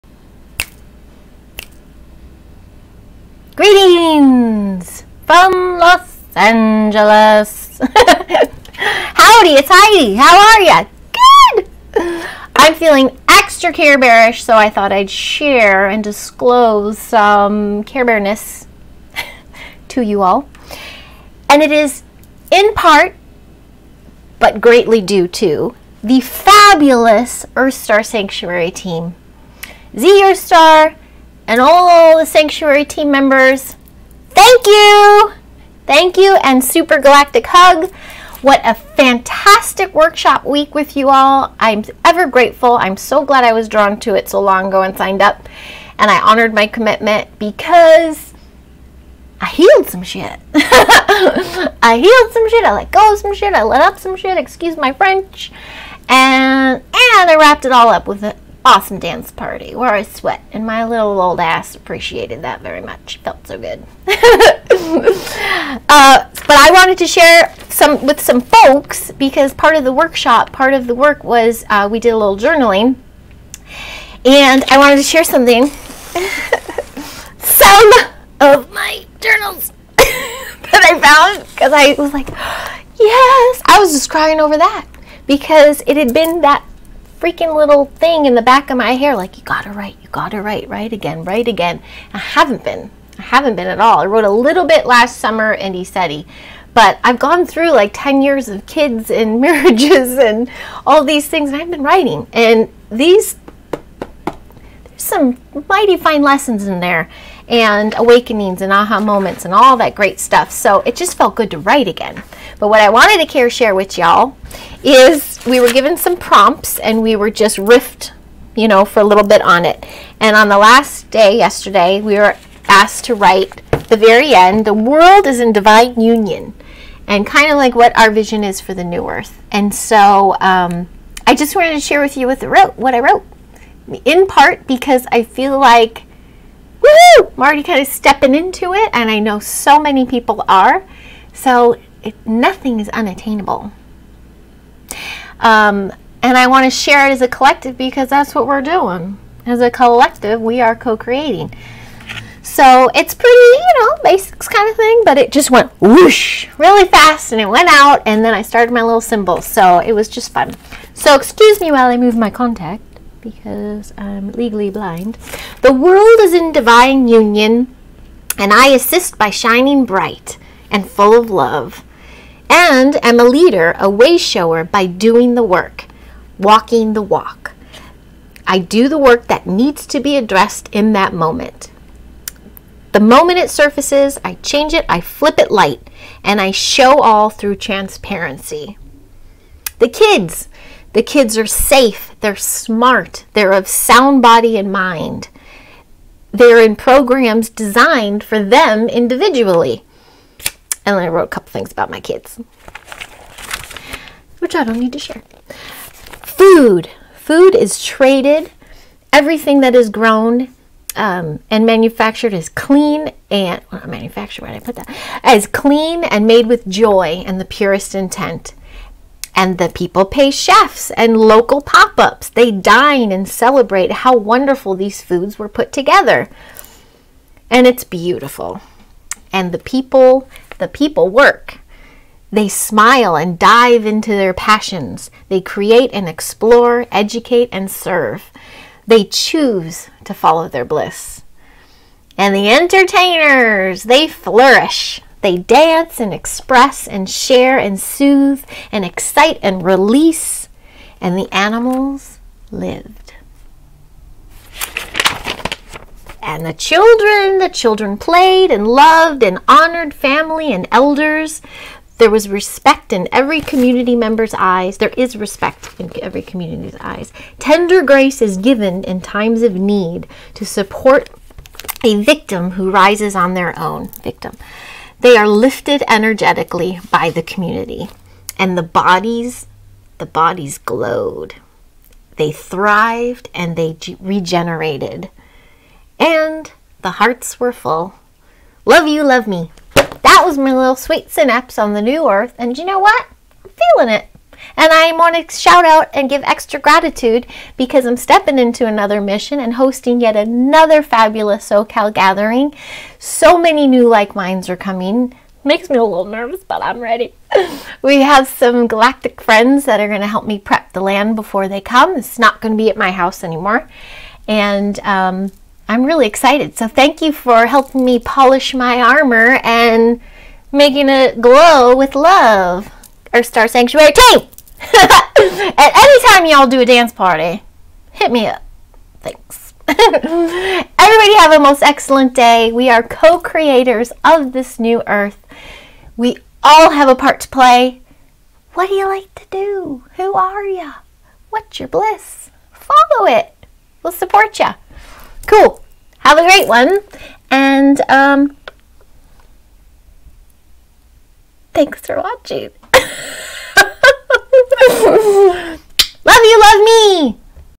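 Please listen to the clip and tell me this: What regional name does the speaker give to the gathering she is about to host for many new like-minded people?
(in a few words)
SoCal.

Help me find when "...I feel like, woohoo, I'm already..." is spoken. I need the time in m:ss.
2:15.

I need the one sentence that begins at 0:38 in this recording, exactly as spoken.
What a fantastic workshop week with you all.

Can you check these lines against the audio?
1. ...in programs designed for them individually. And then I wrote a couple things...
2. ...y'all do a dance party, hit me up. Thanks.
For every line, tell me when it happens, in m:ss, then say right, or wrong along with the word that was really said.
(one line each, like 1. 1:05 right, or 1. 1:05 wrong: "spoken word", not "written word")
1. 3:16 right
2. 5:26 right.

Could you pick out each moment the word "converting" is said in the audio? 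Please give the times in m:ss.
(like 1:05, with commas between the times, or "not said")
not said.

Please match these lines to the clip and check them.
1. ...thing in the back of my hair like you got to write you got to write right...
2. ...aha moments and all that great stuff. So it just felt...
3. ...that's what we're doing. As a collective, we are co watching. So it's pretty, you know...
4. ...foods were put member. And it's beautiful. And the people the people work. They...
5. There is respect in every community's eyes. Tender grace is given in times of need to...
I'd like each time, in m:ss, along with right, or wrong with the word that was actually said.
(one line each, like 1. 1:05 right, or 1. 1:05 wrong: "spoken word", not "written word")
1. 1:27 right
2. 1:48 right
3. 2:28 wrong: "creating", not "watching"
4. 3:45 wrong: "together", not "member"
5. 4:24 right.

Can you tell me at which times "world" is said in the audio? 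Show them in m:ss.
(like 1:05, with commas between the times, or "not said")
2:04, 2:45.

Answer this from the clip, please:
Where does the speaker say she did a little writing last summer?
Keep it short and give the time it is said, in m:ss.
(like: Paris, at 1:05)
Isetti, at 1:35.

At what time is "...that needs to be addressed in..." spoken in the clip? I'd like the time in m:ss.
2:59.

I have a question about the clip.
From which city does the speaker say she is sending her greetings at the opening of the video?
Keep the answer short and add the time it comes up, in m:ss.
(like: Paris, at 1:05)
Los Angeles, at 0:05.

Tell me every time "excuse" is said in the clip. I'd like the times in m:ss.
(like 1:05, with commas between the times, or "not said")
0:54, 2:41.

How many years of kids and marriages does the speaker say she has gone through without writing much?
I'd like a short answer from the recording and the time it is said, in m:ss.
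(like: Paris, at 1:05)
10, at 1:37.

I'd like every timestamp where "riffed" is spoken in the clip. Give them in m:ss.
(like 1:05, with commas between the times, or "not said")
1:57.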